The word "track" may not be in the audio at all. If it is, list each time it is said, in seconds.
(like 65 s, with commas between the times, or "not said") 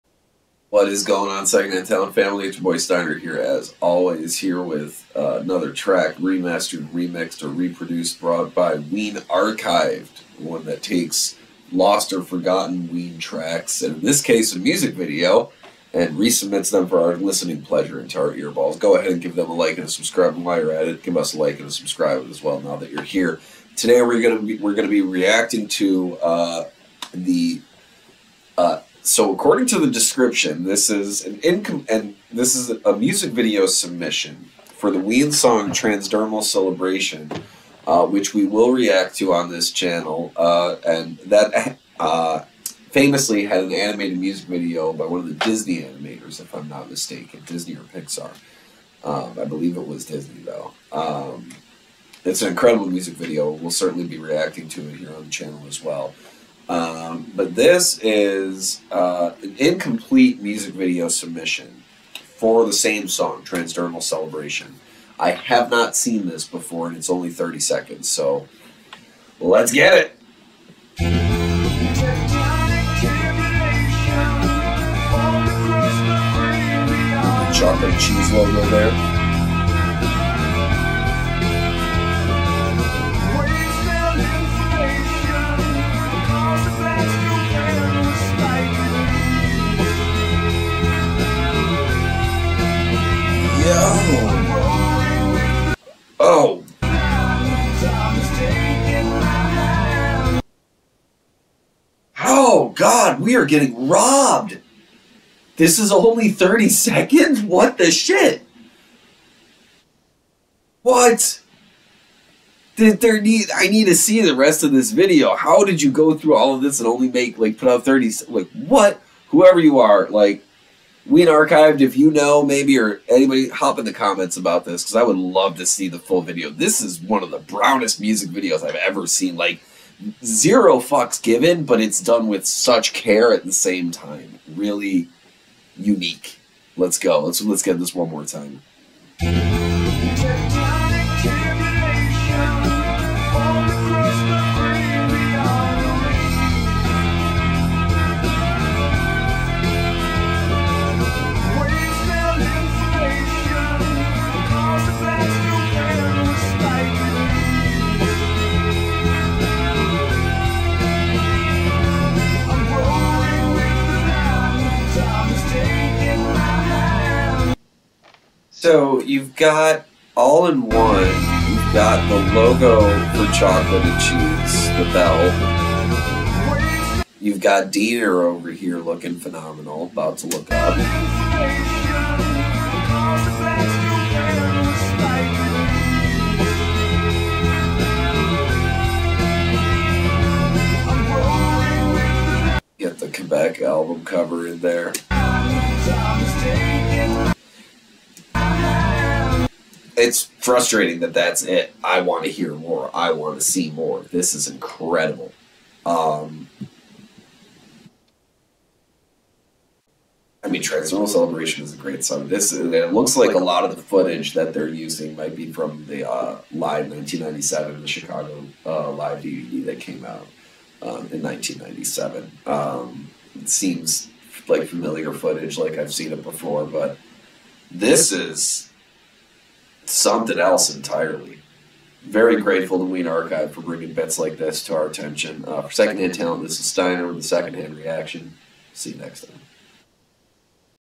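5 s, 13 s.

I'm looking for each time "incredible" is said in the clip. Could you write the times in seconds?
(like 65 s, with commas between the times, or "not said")
52 s, 204 s.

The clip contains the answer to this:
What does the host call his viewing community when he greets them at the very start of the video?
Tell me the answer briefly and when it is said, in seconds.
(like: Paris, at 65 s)
Secondhand Talent Town, at 1 s.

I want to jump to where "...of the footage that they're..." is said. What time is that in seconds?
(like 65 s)
213 s.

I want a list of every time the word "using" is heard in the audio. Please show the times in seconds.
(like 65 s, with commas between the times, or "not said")
214 s.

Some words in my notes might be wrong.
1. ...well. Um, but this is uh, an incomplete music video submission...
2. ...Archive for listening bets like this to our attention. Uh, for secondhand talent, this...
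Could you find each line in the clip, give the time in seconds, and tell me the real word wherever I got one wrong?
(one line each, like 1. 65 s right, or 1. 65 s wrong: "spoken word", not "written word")
1. 55 s right
2. 233 s wrong: "bringing", not "listening".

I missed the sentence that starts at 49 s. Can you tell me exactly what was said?
Um, I believe it was Disney though.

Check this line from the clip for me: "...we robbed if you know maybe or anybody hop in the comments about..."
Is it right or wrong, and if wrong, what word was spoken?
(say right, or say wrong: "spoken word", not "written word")
wrong: "archived", not "robbed".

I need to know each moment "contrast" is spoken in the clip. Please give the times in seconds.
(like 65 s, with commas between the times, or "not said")
not said.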